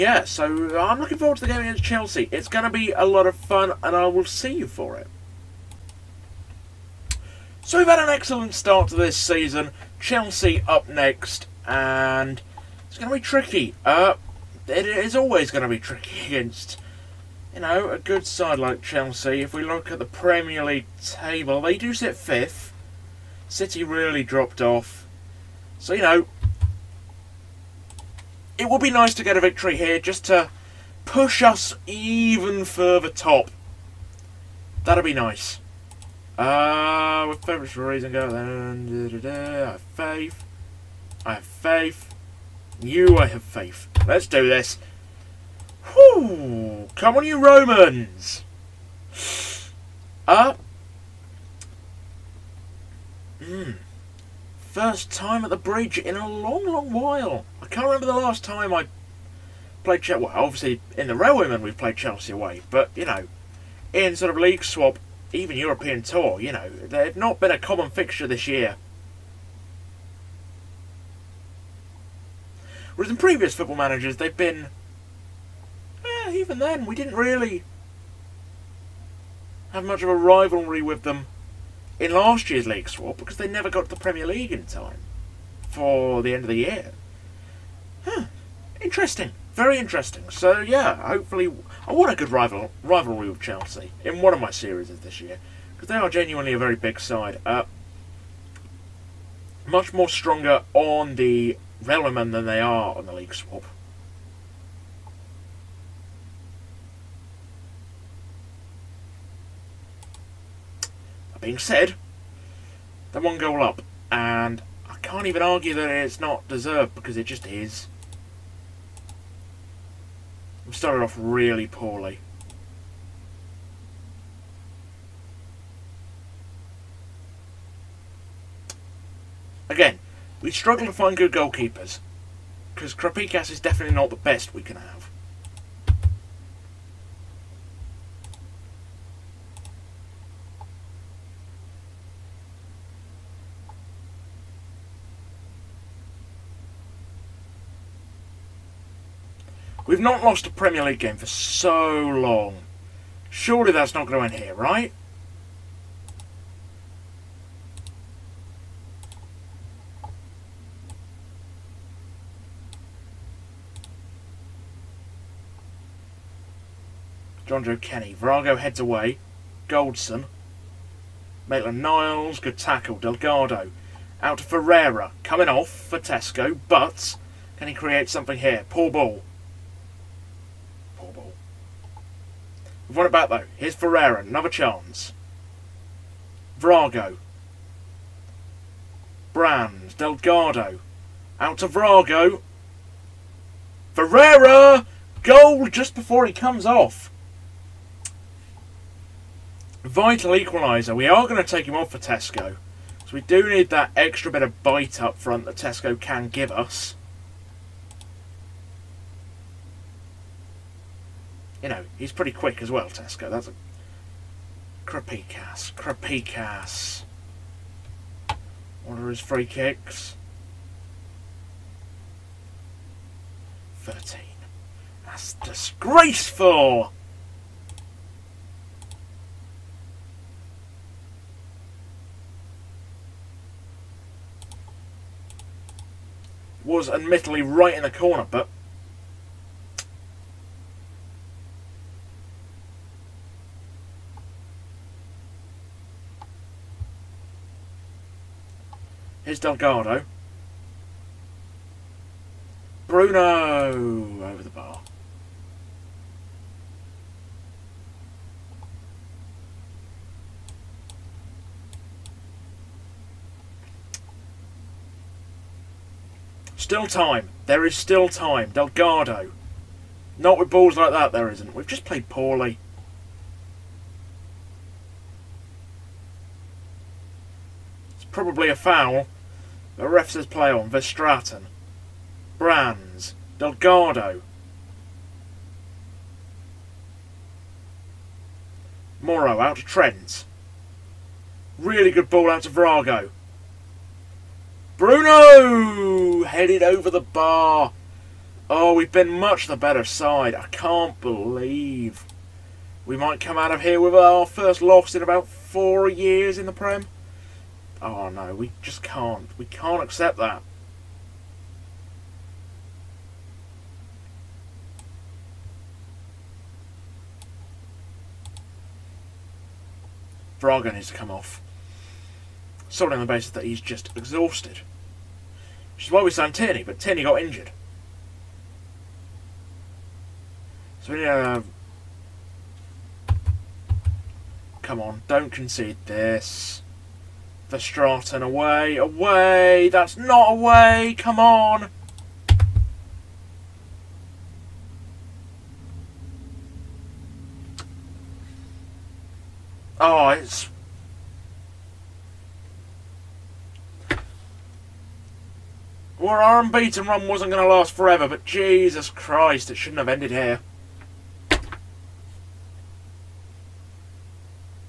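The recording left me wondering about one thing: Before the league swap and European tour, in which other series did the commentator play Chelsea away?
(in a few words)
The Railwaymen.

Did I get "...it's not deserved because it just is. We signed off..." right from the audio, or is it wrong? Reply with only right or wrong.
wrong.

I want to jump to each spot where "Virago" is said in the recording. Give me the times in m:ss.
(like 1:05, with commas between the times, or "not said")
2:48, 4:52.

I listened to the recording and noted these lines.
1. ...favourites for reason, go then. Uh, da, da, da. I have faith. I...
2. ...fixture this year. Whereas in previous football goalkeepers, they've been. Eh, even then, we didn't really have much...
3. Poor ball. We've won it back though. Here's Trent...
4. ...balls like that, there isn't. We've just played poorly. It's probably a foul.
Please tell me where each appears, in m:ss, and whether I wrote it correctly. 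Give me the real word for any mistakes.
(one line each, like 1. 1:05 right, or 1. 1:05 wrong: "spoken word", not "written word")
1. 0:37 right
2. 1:07 wrong: "managers", not "goalkeepers"
3. 2:58 wrong: "Ferreira", not "Trent"
4. 4:30 right.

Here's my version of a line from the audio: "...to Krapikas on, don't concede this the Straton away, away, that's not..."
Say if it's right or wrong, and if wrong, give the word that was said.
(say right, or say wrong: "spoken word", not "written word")
wrong: "Come", not "Krapikas".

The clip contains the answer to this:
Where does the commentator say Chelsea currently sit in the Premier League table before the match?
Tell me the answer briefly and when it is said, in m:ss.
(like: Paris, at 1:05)
Fifth, at 0:22.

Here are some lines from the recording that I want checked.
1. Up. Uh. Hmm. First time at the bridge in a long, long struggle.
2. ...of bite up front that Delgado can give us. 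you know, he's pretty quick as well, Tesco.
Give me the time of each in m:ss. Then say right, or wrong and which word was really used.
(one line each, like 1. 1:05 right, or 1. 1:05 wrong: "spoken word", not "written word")
1. 0:50 wrong: "while", not "struggle"
2. 3:24 wrong: "Tesco", not "Delgado".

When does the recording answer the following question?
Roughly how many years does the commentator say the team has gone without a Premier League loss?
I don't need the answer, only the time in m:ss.
5:05.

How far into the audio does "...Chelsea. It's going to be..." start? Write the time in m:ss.
0:01.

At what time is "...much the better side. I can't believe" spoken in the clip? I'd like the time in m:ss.
4:59.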